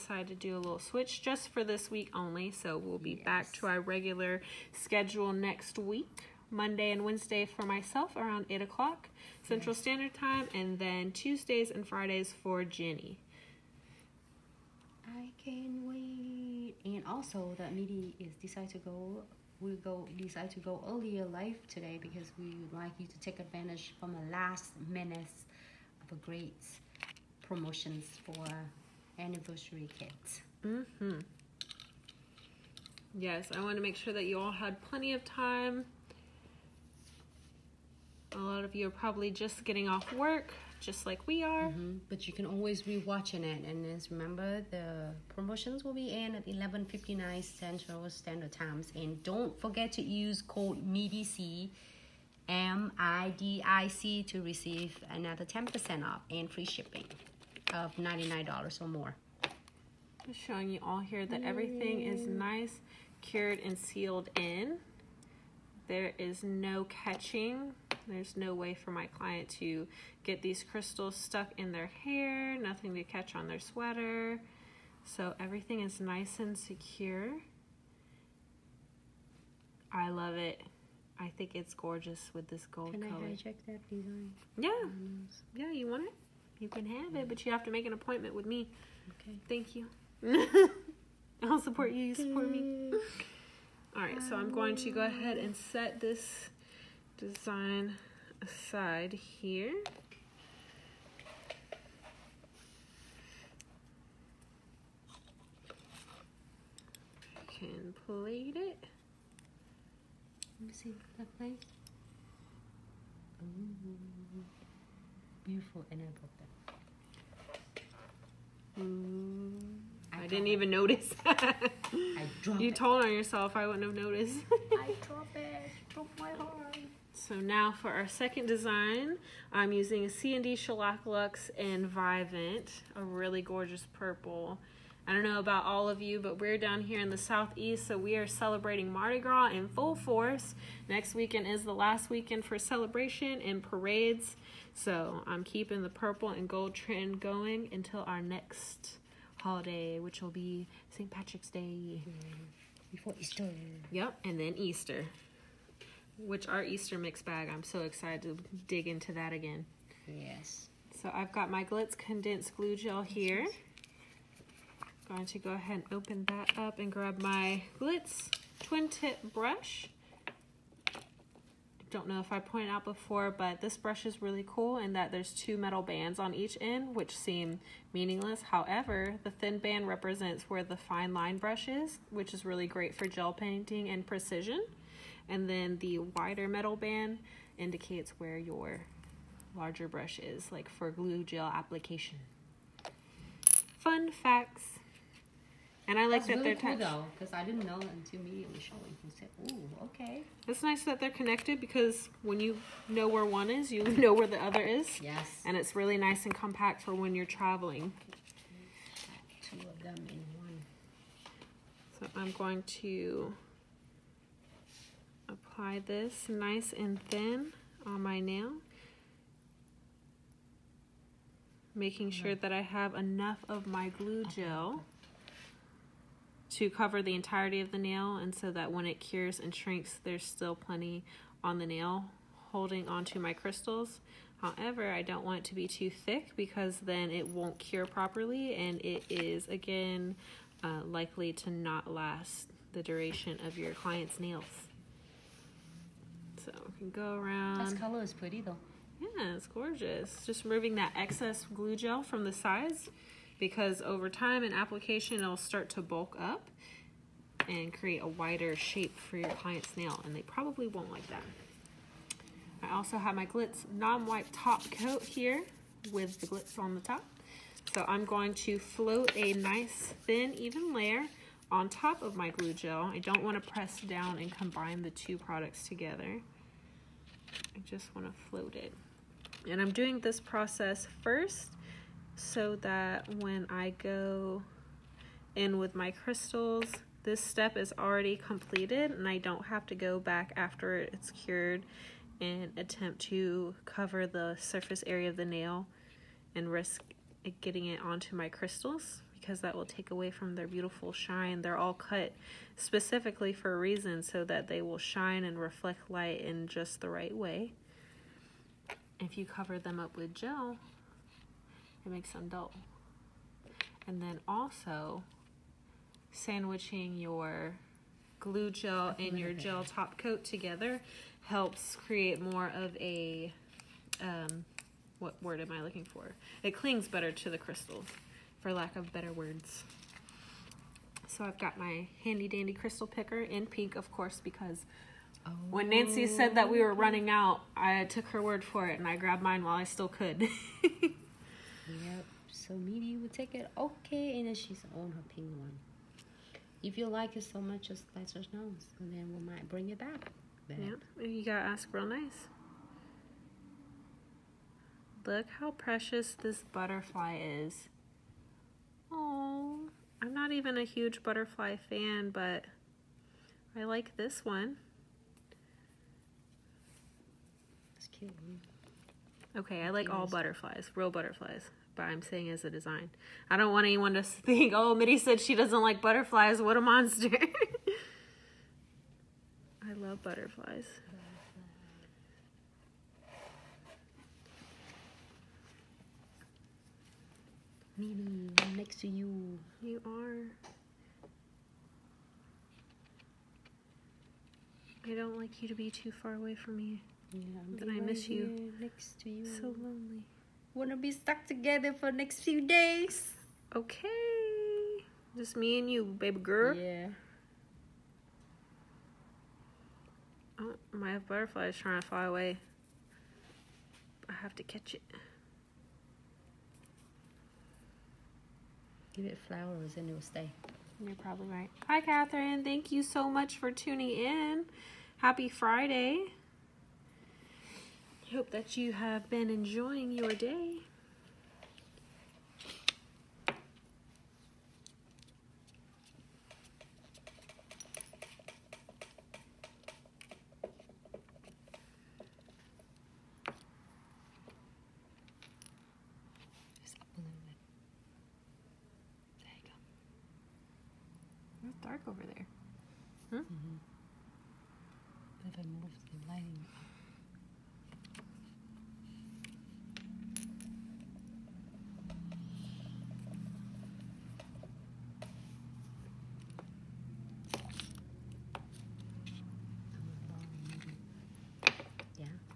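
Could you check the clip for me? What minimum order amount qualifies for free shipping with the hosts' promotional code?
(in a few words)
$99.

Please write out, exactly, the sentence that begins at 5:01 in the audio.
They're all cut specifically for a reason so that they will shine and reflect light in just the right way.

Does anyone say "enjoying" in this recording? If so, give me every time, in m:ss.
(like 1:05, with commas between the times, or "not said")
7:09.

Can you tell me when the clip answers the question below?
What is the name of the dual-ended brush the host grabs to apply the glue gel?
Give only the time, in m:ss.
2:47.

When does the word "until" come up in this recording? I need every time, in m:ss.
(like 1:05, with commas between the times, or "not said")
2:27, 3:17.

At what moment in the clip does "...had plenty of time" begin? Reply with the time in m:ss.
0:34.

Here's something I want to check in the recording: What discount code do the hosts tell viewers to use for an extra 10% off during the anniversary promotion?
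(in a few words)
MIDIC.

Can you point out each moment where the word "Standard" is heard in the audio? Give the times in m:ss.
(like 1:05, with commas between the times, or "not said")
0:09, 0:48.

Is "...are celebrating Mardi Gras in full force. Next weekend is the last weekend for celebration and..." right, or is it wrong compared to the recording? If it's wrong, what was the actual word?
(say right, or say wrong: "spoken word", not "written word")
right.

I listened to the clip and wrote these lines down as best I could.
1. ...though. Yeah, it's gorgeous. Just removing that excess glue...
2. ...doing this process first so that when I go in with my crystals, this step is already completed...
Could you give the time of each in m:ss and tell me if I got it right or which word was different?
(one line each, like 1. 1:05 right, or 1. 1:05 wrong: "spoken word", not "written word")
1. 4:08 right
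2. 4:39 right.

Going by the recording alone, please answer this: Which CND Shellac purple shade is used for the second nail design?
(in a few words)
Luxe and Vivant.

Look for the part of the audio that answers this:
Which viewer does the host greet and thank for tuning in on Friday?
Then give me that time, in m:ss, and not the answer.
7:01.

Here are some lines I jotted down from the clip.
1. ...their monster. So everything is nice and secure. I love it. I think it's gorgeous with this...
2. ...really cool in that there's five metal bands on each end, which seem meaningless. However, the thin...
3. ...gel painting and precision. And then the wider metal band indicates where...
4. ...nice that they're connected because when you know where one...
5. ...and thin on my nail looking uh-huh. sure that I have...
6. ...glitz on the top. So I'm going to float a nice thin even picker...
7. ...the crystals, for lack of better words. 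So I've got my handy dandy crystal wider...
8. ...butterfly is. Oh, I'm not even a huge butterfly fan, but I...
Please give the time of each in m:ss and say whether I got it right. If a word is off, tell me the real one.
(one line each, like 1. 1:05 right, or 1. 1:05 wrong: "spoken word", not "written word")
1. 1:13 wrong: "sweater", not "monster"
2. 2:54 wrong: "two", not "five"
3. 3:03 right
4. 3:20 right
5. 3:36 wrong: "making", not "looking"
6. 4:26 wrong: "layer", not "picker"
7. 5:27 wrong: "picker", not "wider"
8. 5:56 right.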